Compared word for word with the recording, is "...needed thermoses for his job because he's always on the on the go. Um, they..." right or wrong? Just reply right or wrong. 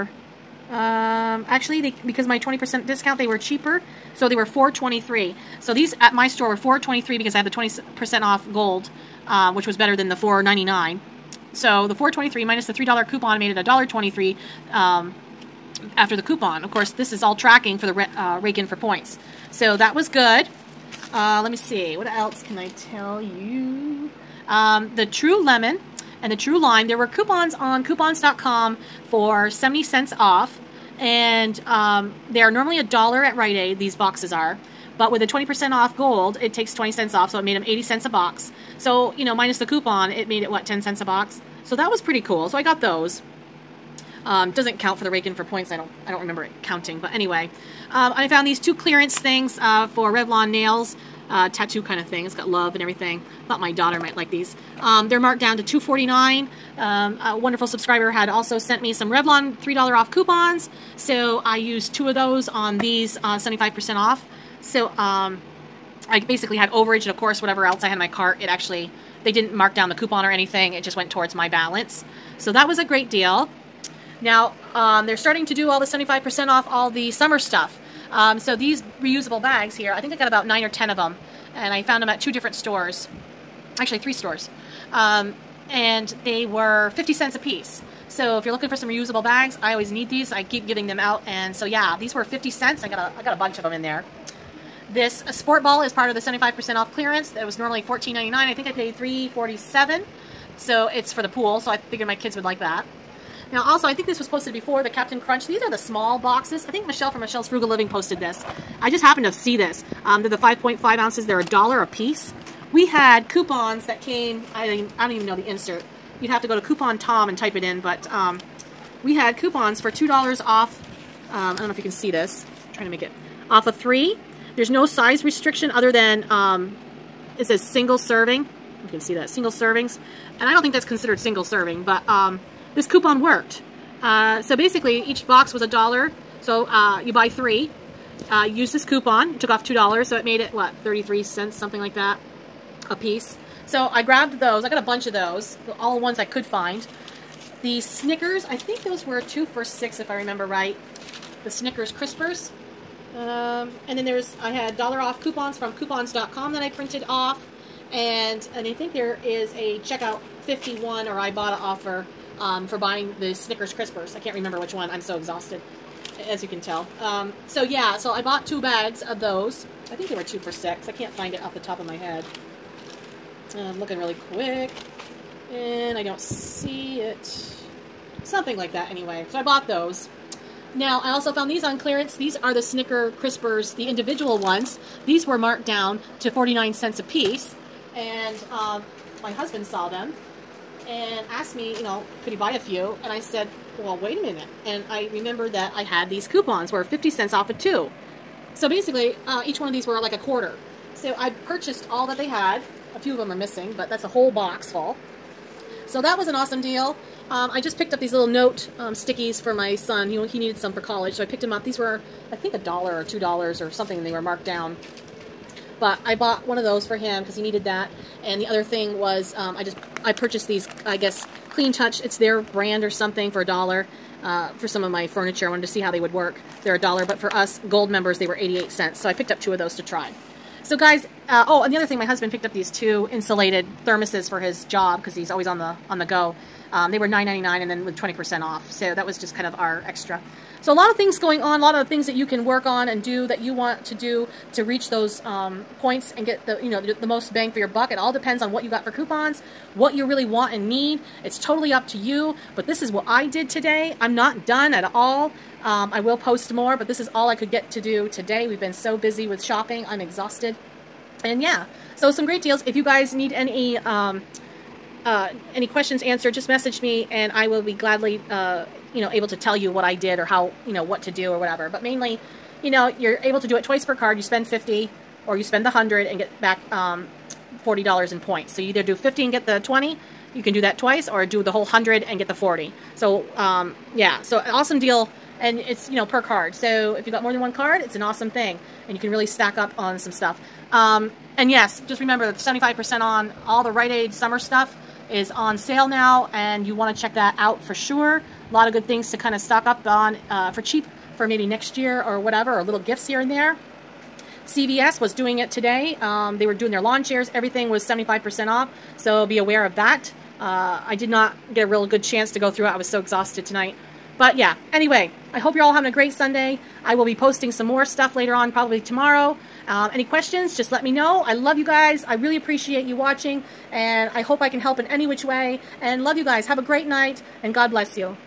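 wrong.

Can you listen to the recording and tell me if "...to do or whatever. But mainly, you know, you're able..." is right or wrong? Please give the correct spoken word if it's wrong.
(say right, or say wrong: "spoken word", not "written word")
right.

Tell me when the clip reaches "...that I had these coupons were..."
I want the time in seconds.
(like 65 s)
195 s.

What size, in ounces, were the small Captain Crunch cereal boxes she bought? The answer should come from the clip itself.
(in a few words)
5.5 ounces.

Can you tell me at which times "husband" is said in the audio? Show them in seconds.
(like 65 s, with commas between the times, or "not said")
189 s, 232 s.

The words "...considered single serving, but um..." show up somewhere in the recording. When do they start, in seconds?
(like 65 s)
130 s.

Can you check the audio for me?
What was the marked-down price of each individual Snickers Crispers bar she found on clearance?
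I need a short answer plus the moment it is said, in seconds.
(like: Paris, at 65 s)
49 cents, at 186 s.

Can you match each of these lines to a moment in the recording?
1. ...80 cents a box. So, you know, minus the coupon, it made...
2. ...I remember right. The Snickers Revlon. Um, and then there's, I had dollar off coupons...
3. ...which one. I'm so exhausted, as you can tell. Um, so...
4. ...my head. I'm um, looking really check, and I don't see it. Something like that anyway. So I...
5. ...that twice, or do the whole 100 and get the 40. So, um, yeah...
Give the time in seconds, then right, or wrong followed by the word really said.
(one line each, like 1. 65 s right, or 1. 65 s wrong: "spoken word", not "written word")
1. 37 s right
2. 150 s wrong: "Crispers", not "Revlon"
3. 164 s right
4. 171 s wrong: "quick", not "check"
5. 280 s right.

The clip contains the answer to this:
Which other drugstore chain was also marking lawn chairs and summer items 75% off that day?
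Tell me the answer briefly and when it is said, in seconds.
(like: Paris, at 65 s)
CVS, at 304 s.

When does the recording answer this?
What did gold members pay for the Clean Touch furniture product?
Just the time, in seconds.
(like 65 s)
228 s.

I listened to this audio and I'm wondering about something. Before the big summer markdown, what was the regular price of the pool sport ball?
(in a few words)
$14.99.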